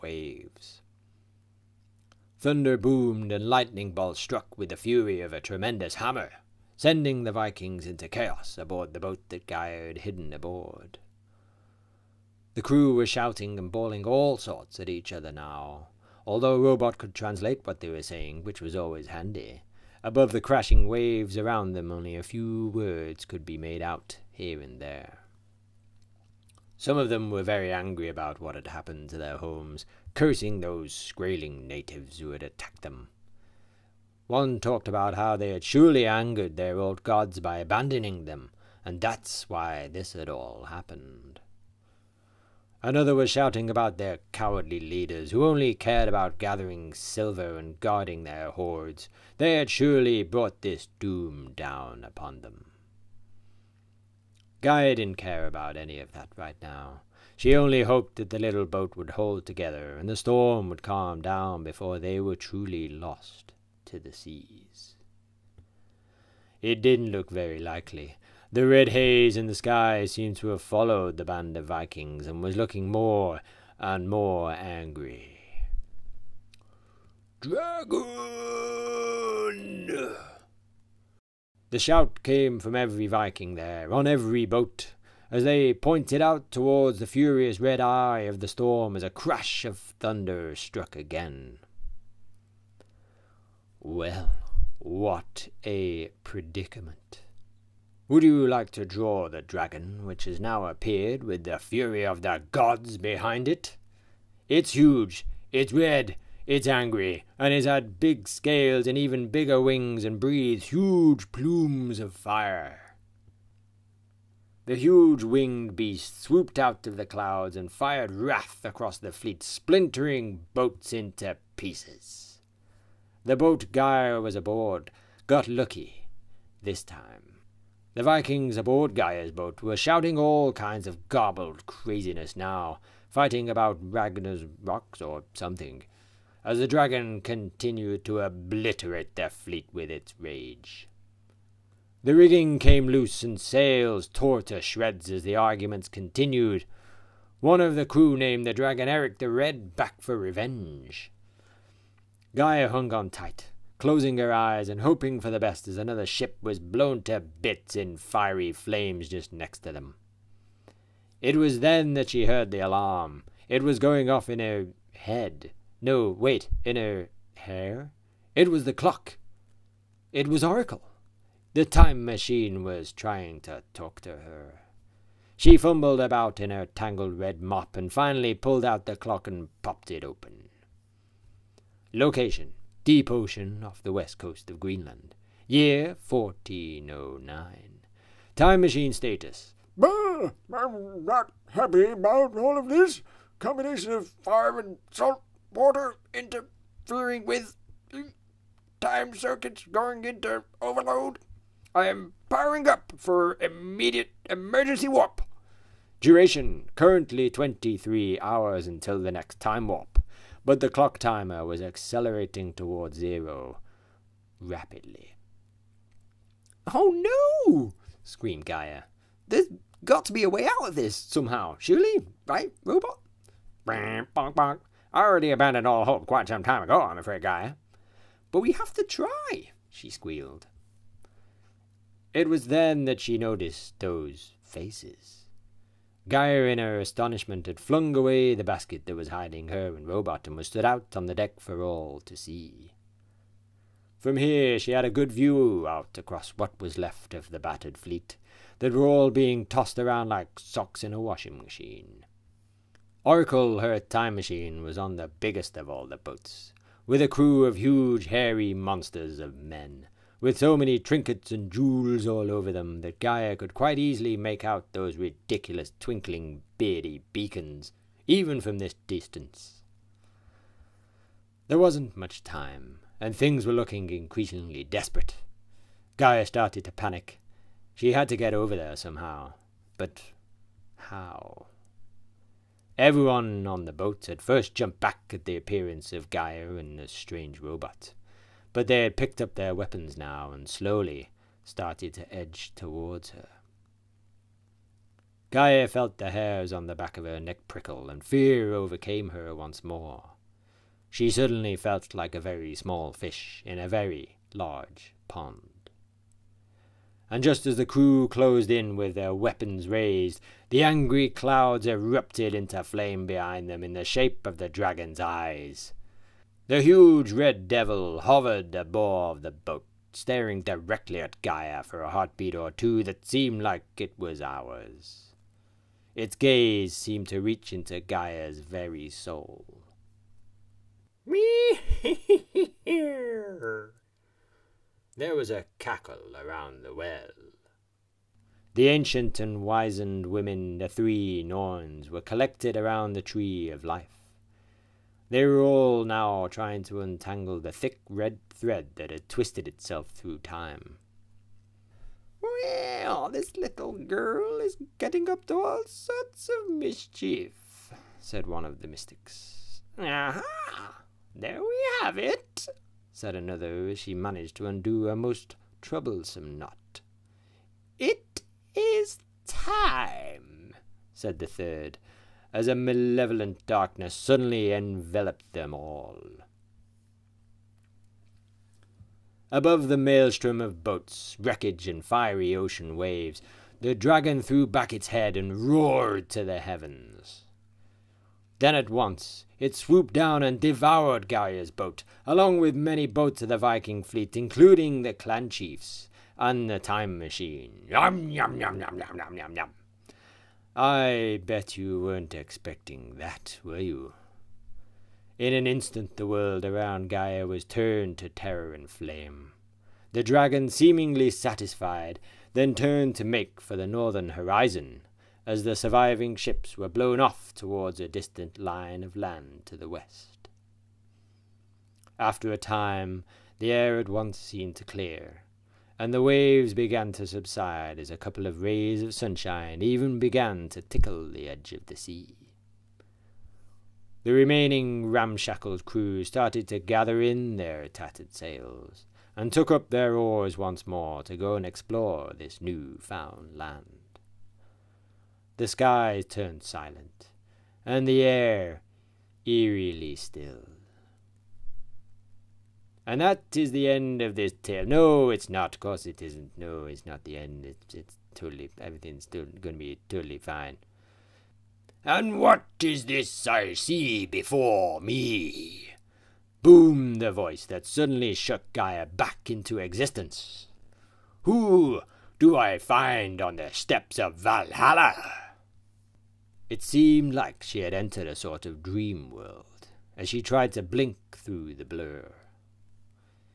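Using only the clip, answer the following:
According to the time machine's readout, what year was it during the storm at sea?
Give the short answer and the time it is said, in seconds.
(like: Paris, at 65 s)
1409, at 186 s.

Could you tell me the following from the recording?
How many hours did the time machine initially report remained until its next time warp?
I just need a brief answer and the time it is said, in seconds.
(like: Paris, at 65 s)
23, at 207 s.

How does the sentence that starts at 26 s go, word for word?
Some of them were very angry about what had happened to their homes, cursing those Skraeling natives who had attacked them.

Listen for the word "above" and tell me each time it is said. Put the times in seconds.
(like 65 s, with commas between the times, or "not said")
20 s, 318 s, 379 s.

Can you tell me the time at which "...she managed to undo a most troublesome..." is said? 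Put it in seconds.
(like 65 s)
363 s.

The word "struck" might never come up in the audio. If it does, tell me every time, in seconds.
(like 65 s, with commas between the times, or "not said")
4 s, 90 s.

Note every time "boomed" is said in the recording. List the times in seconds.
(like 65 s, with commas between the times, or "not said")
2 s, 466 s.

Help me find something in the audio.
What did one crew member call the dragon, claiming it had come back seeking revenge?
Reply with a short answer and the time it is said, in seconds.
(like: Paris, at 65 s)
Eric the Red, at 148 s.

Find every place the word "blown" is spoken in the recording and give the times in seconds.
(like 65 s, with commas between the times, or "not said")
156 s, 416 s.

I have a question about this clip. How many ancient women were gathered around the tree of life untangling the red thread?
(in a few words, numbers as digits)
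3.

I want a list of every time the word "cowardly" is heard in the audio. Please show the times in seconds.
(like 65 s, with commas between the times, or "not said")
44 s.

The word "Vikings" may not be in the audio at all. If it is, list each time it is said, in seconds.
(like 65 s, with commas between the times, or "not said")
7 s, 71 s, 83 s, 128 s, 393 s.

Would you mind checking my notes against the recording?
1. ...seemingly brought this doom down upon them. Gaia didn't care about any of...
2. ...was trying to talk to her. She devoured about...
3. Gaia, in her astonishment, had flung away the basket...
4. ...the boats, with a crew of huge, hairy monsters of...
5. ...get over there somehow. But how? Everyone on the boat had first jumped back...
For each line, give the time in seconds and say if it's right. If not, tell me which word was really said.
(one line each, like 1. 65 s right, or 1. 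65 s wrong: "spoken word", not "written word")
1. 49 s wrong: "surely", not "seemingly"
2. 172 s wrong: "fumbled", not "devoured"
3. 236 s right
4. 255 s right
5. 278 s right.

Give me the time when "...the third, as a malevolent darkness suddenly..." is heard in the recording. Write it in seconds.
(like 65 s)
371 s.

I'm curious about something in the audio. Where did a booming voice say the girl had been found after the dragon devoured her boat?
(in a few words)
Steps of Valhalla.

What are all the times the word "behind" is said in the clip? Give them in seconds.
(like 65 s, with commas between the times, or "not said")
102 s, 313 s.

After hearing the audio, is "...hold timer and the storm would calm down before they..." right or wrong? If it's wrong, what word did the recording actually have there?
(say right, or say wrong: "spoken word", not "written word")
wrong: "together", not "timer".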